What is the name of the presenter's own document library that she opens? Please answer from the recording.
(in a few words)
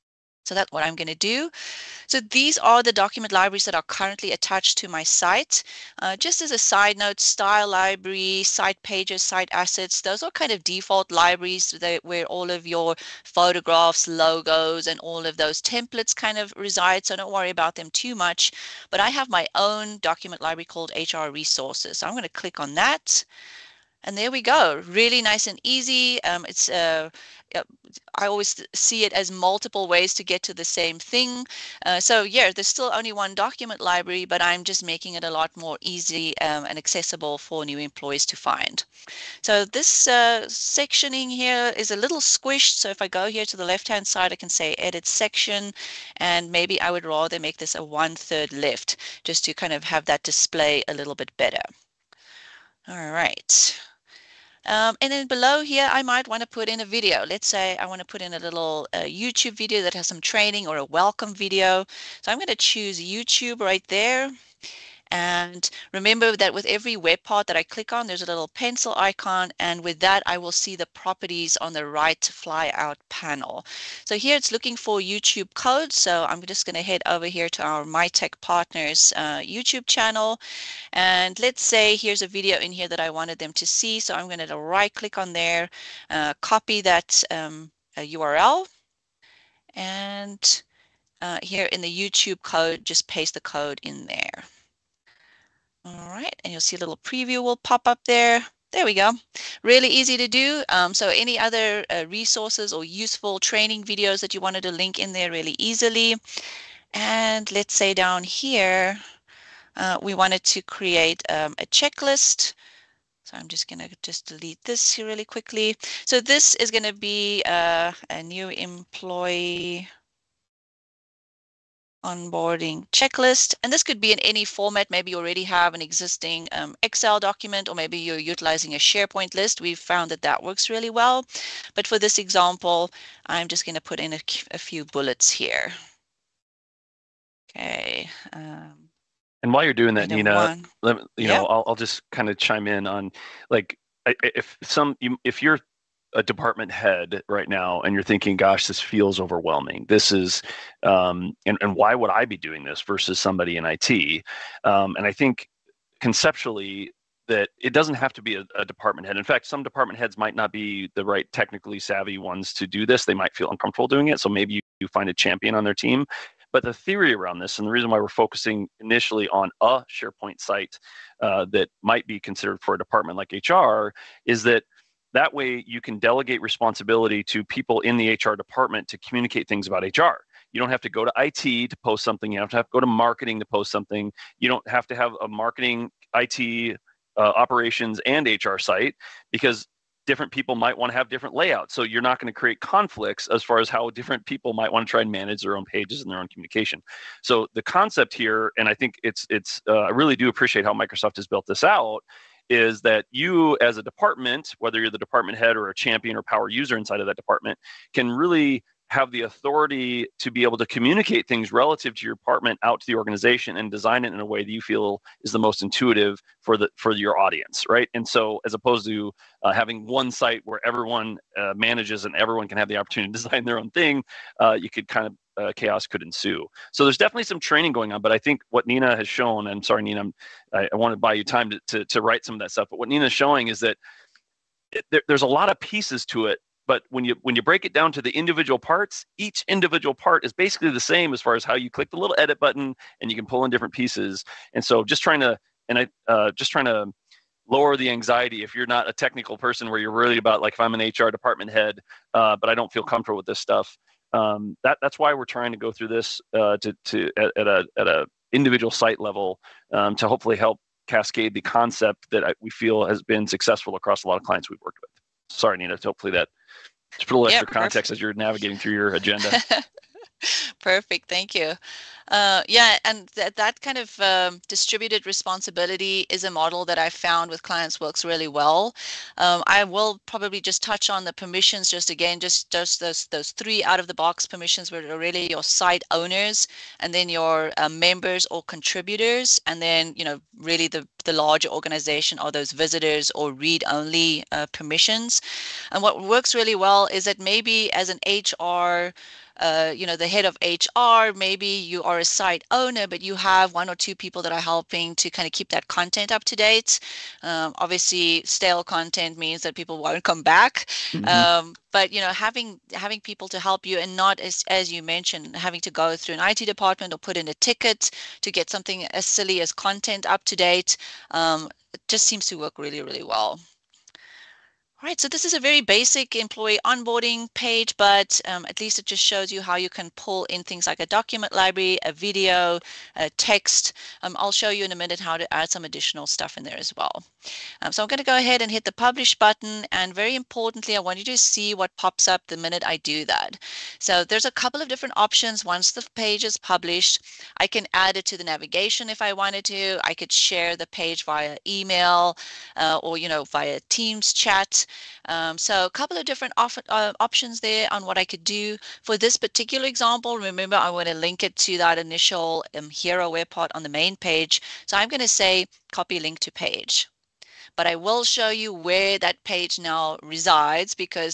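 HR Resources.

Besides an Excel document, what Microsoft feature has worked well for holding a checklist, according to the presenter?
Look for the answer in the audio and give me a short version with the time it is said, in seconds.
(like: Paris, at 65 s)
SharePoint list, at 128 s.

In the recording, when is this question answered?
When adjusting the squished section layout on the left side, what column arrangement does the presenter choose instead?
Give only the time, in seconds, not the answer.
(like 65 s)
47 s.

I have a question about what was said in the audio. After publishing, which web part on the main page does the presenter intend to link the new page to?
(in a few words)
hero web part.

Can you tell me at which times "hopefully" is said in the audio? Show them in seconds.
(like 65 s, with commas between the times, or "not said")
260 s, 265 s.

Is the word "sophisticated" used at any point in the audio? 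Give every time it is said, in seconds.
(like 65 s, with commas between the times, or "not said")
not said.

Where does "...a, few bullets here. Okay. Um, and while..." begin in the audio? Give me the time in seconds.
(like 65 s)
134 s.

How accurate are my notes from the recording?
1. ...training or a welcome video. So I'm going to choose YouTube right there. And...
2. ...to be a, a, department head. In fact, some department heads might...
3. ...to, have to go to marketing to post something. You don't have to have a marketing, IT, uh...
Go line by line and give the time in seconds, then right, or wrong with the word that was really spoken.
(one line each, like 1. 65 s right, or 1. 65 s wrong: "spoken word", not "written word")
1. 60 s right
2. 158 s right
3. 182 s right.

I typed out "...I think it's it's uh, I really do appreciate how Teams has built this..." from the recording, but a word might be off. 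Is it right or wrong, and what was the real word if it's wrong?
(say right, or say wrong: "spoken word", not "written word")
wrong: "Microsoft", not "Teams".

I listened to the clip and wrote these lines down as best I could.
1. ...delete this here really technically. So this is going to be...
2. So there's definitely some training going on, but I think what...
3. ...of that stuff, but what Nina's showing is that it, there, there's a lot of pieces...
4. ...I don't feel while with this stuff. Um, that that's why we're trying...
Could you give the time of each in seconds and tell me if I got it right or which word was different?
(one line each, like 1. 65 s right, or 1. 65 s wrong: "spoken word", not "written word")
1. 114 s wrong: "quickly", not "technically"
2. 226 s right
3. 232 s right
4. 252 s wrong: "comfortable", not "while".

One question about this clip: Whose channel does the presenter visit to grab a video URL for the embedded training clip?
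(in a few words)
MyTech Partners.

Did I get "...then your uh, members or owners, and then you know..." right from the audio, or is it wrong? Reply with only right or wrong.
wrong.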